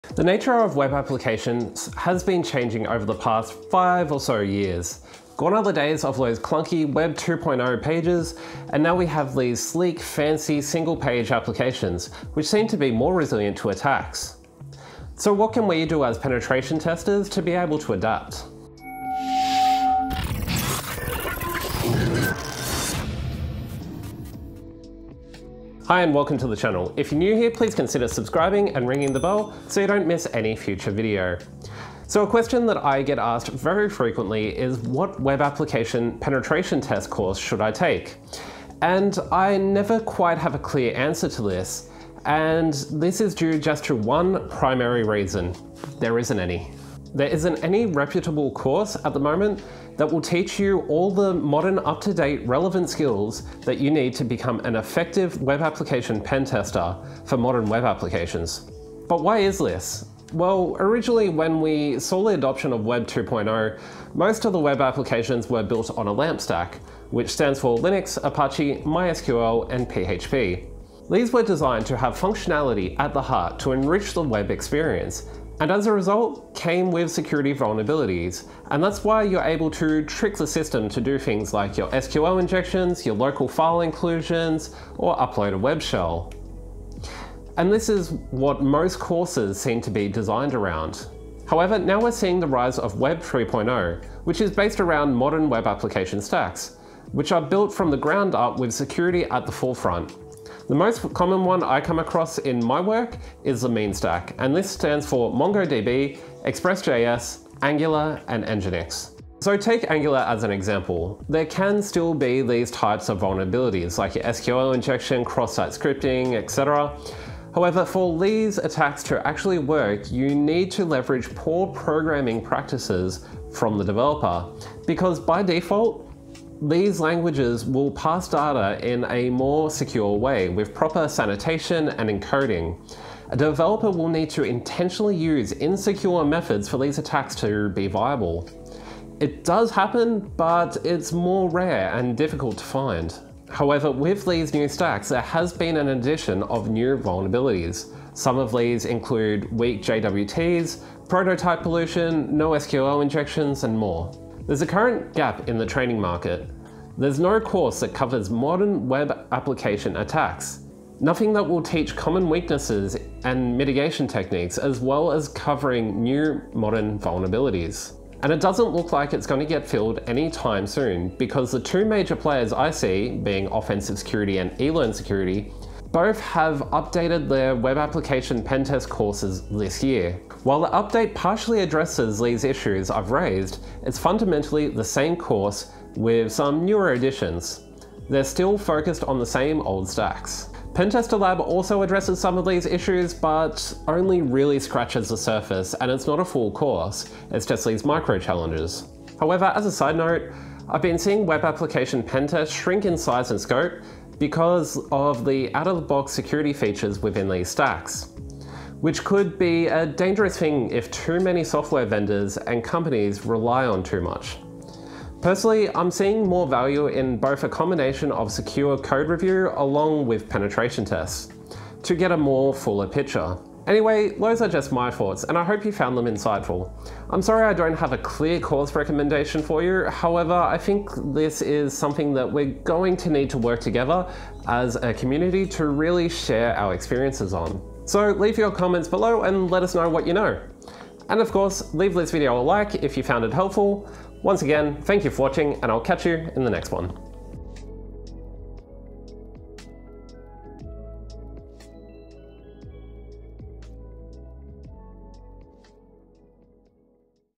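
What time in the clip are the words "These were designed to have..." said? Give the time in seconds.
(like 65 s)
71 s.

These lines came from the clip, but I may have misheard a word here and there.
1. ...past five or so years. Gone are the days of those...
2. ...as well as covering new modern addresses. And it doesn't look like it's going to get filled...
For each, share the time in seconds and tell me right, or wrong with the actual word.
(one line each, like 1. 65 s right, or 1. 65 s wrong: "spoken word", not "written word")
1. 3 s right
2. 164 s wrong: "vulnerabilities", not "addresses".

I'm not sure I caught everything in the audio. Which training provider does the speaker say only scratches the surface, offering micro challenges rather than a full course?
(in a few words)
Pentester Lab.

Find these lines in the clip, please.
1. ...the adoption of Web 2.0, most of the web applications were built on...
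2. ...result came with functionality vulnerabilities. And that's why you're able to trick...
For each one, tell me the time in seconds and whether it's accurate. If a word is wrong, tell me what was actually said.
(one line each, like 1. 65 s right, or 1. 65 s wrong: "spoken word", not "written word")
1. 62 s right
2. 75 s wrong: "security", not "functionality".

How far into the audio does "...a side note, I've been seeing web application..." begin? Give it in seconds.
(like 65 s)
199 s.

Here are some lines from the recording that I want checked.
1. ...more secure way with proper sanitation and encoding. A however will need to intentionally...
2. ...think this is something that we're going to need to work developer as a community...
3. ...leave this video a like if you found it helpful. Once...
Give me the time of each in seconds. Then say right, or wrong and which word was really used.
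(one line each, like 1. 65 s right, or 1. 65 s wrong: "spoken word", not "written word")
1. 129 s wrong: "developer", not "however"
2. 230 s wrong: "together", not "developer"
3. 241 s right.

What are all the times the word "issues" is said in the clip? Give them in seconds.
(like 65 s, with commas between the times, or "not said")
182 s, 192 s.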